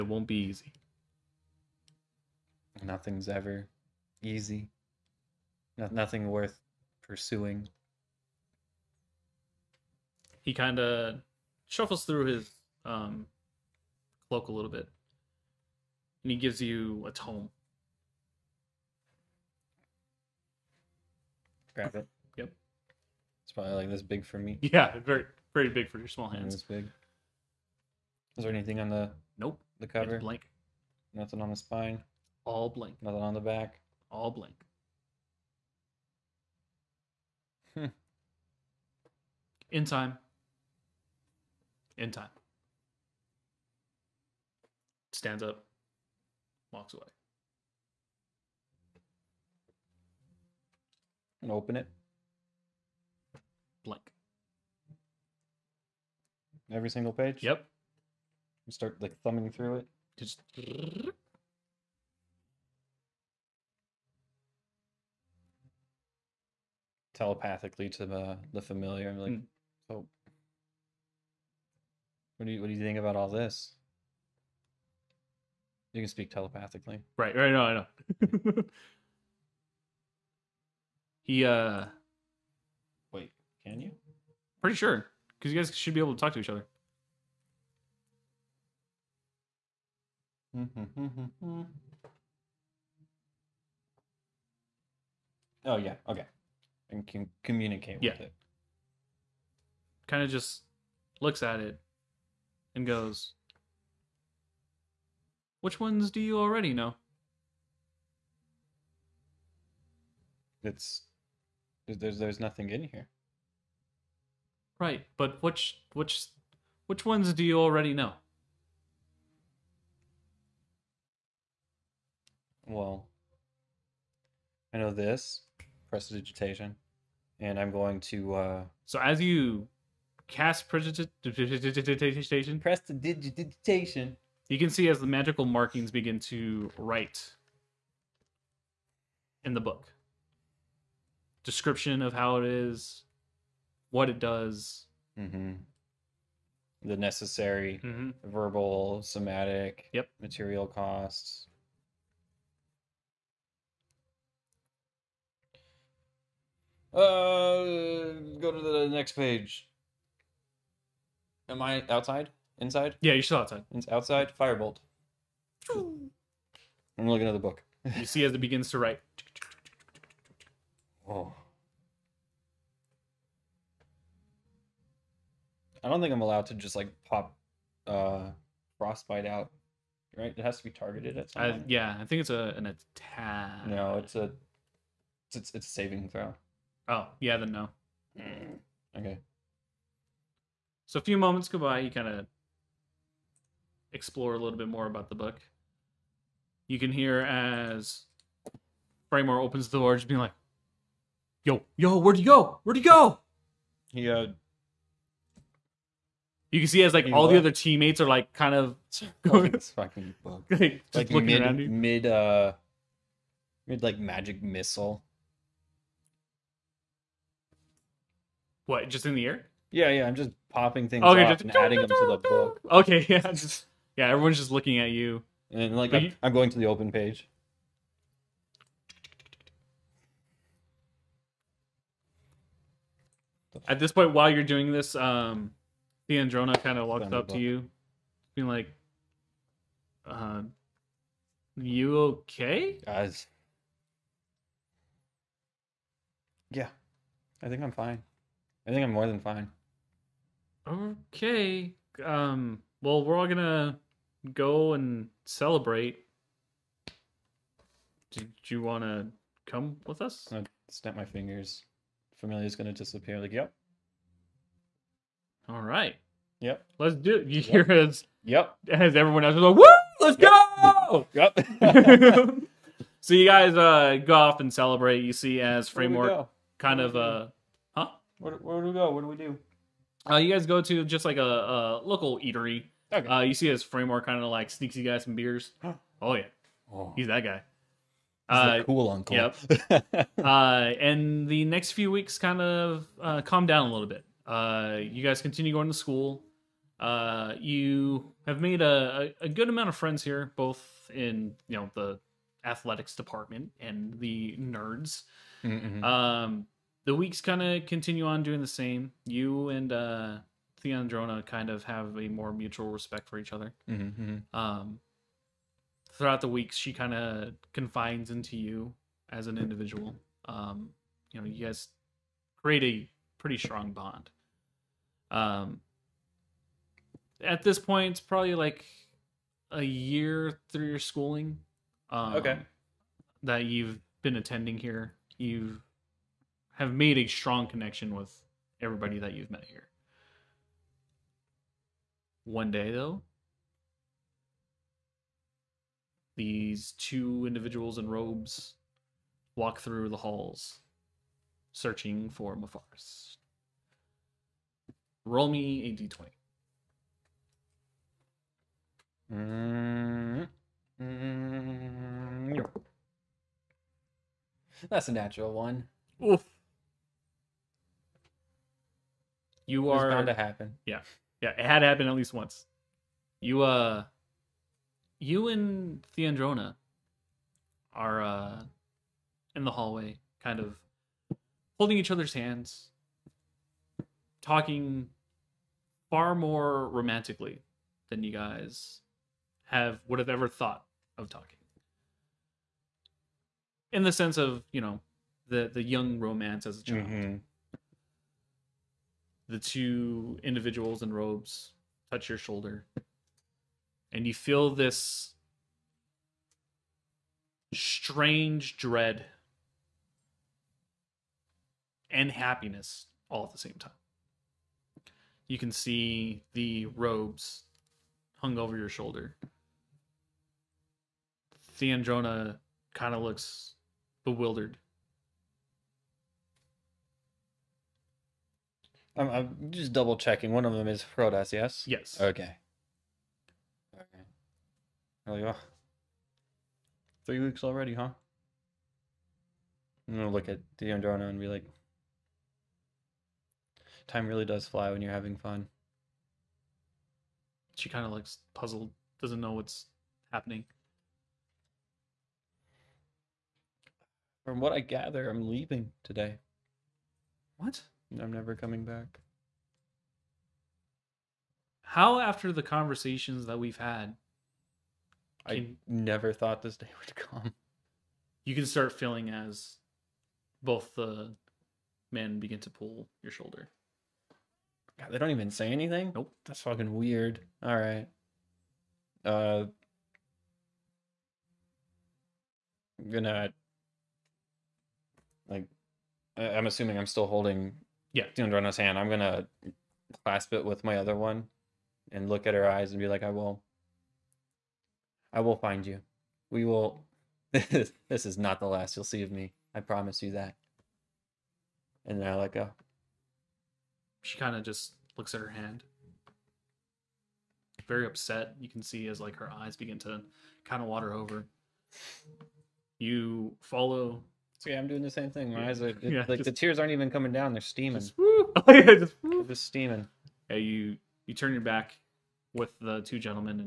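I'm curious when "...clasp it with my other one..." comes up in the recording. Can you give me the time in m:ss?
8:10.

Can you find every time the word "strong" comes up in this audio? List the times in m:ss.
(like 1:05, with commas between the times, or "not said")
5:23, 5:37.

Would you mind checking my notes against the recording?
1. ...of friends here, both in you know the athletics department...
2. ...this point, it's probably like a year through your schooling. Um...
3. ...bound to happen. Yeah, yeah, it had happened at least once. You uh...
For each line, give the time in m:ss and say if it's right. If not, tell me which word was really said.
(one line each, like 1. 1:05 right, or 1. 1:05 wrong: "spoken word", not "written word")
1. 4:59 right
2. 5:27 right
3. 6:09 right.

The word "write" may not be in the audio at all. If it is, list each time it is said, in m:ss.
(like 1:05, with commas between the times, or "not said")
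2:16, 2:48.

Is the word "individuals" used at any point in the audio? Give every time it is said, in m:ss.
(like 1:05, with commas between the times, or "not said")
5:19, 5:47, 6:40.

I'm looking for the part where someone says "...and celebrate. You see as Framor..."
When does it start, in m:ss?
4:34.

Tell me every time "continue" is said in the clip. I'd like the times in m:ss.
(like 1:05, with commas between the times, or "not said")
4:55, 5:07.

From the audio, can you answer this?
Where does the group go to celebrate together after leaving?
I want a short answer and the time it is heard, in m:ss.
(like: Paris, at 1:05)
A local eatery, at 4:41.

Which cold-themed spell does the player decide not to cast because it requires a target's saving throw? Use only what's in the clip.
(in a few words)
Frostbite.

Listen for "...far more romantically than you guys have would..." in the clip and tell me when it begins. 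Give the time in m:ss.
6:25.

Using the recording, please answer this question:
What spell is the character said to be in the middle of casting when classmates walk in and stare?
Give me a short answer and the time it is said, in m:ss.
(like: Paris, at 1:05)
Magic missile, at 3:33.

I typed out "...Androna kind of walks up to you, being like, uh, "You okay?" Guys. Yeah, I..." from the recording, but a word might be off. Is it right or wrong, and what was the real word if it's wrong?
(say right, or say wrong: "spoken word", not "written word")
right.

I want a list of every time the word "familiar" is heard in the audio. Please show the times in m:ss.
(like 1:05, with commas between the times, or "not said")
1:08, 4:22.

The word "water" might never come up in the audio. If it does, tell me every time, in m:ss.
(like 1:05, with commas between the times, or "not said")
8:30.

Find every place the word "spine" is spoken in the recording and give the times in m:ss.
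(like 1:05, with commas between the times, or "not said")
0:31.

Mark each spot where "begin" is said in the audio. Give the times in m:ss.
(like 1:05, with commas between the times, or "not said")
2:15, 2:48, 7:52, 8:29.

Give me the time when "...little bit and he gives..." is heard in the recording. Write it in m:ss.
0:14.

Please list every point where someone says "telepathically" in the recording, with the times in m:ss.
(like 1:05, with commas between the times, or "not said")
1:07, 1:16.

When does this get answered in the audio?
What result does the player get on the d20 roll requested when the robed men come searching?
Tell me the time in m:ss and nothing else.
6:04.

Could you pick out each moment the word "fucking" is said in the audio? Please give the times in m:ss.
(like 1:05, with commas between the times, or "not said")
3:29, 7:56.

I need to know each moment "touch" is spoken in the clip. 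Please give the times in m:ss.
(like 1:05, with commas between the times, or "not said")
6:41.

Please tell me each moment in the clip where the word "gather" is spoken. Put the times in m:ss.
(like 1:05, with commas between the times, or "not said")
7:34.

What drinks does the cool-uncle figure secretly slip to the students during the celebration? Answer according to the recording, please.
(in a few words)
Beers.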